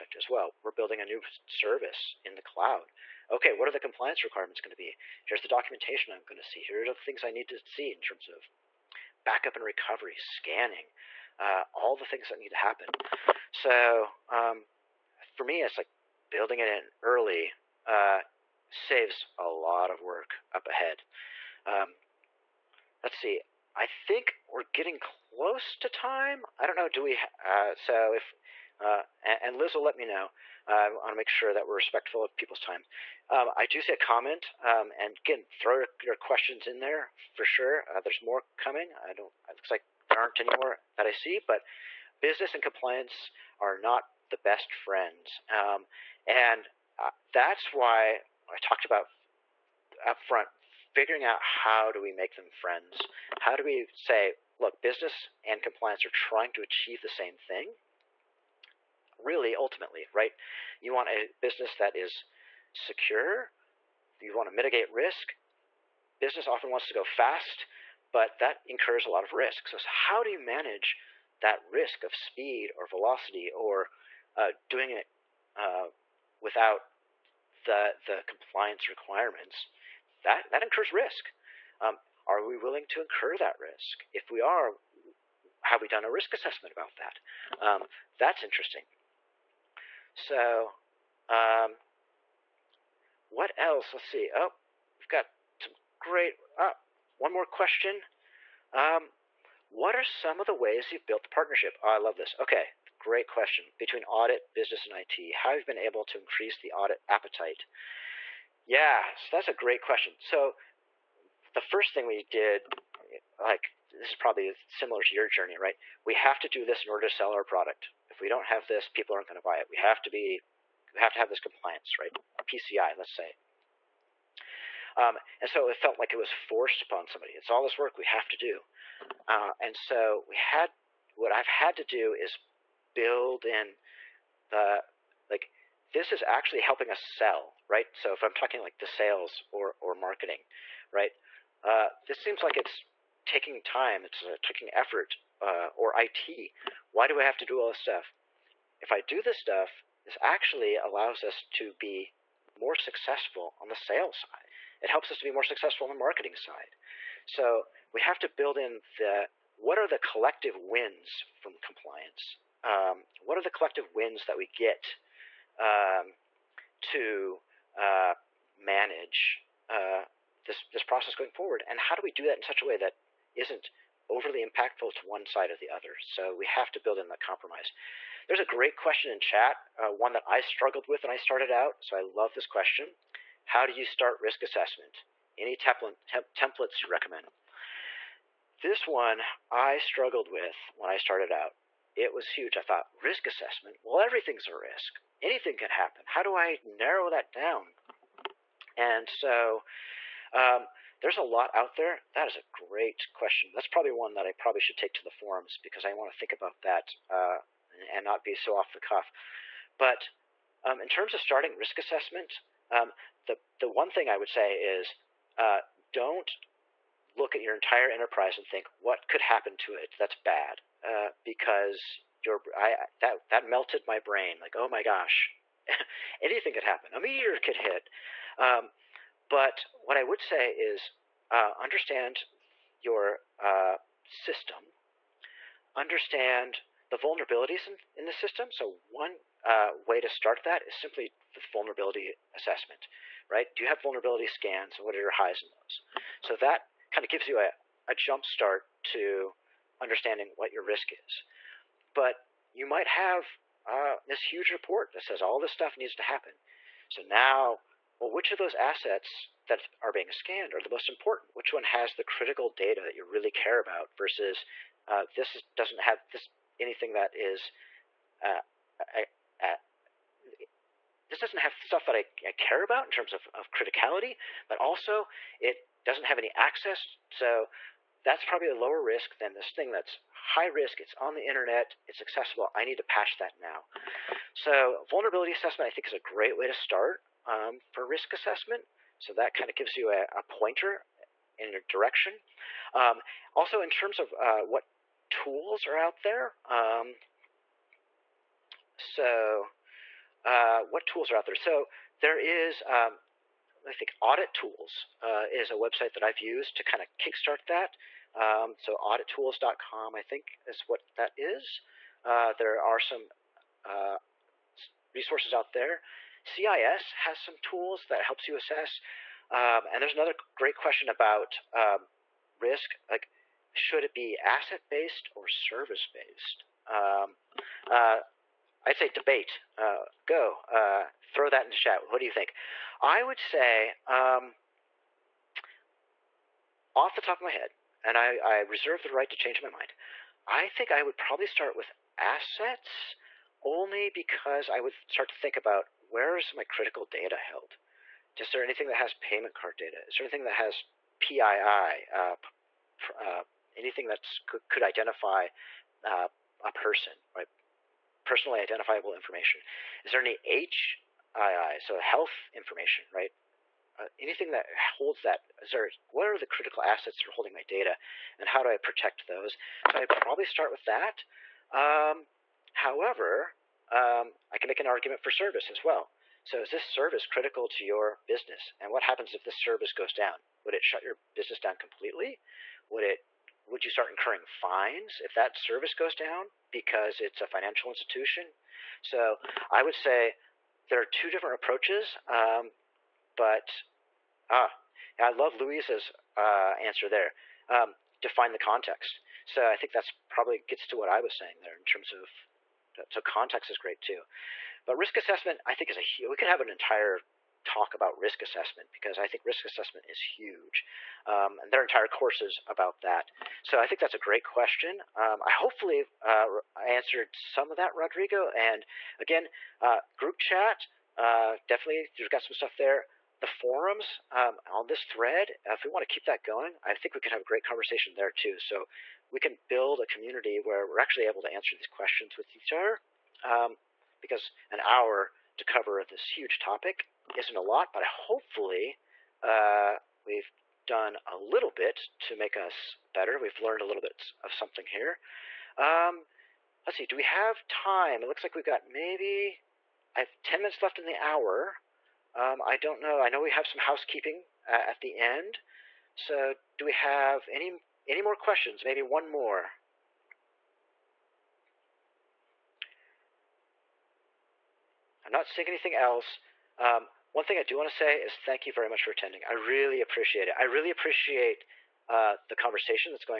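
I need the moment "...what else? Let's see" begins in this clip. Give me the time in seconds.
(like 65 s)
93 s.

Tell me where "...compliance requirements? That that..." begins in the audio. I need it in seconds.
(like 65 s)
78 s.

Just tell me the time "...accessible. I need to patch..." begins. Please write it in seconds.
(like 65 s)
282 s.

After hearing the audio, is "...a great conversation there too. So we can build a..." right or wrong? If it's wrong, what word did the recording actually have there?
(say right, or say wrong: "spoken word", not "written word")
right.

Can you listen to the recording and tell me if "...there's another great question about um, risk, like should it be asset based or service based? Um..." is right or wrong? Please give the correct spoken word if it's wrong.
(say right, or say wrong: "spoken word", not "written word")
right.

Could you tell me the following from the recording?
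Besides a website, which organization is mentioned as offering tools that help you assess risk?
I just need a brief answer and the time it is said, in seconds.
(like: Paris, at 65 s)
CIS, at 316 s.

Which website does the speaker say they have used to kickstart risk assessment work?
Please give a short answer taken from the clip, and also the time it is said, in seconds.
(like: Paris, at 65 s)
audittools.com, at 308 s.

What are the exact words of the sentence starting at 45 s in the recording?
Um, and uh, that's why I talked about upfront figuring out how do we make them friends?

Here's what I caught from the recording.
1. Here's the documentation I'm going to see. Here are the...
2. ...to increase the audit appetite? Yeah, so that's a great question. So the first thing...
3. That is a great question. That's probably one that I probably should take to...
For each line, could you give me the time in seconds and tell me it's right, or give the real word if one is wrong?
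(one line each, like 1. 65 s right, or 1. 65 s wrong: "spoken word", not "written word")
1. 5 s right
2. 106 s right
3. 202 s right.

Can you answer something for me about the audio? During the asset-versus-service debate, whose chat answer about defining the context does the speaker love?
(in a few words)
Luis.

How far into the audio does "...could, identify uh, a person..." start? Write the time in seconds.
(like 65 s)
354 s.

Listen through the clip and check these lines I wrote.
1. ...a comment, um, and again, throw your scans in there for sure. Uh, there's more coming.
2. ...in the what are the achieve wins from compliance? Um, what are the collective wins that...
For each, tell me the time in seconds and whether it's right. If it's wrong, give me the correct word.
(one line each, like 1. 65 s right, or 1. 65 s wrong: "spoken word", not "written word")
1. 33 s wrong: "questions", not "scans"
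2. 158 s wrong: "collective", not "achieve".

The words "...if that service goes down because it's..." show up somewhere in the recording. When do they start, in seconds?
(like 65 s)
385 s.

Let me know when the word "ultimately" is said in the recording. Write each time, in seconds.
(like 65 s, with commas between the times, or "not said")
59 s.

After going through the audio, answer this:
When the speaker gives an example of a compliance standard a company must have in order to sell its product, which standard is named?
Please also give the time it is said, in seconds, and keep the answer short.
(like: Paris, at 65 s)
PCI, at 122 s.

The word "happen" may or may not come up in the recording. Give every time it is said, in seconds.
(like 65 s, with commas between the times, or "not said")
12 s, 195 s, 219 s, 226 s, 256 s, 378 s.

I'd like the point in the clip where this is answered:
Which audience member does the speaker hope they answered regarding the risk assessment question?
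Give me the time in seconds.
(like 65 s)
417 s.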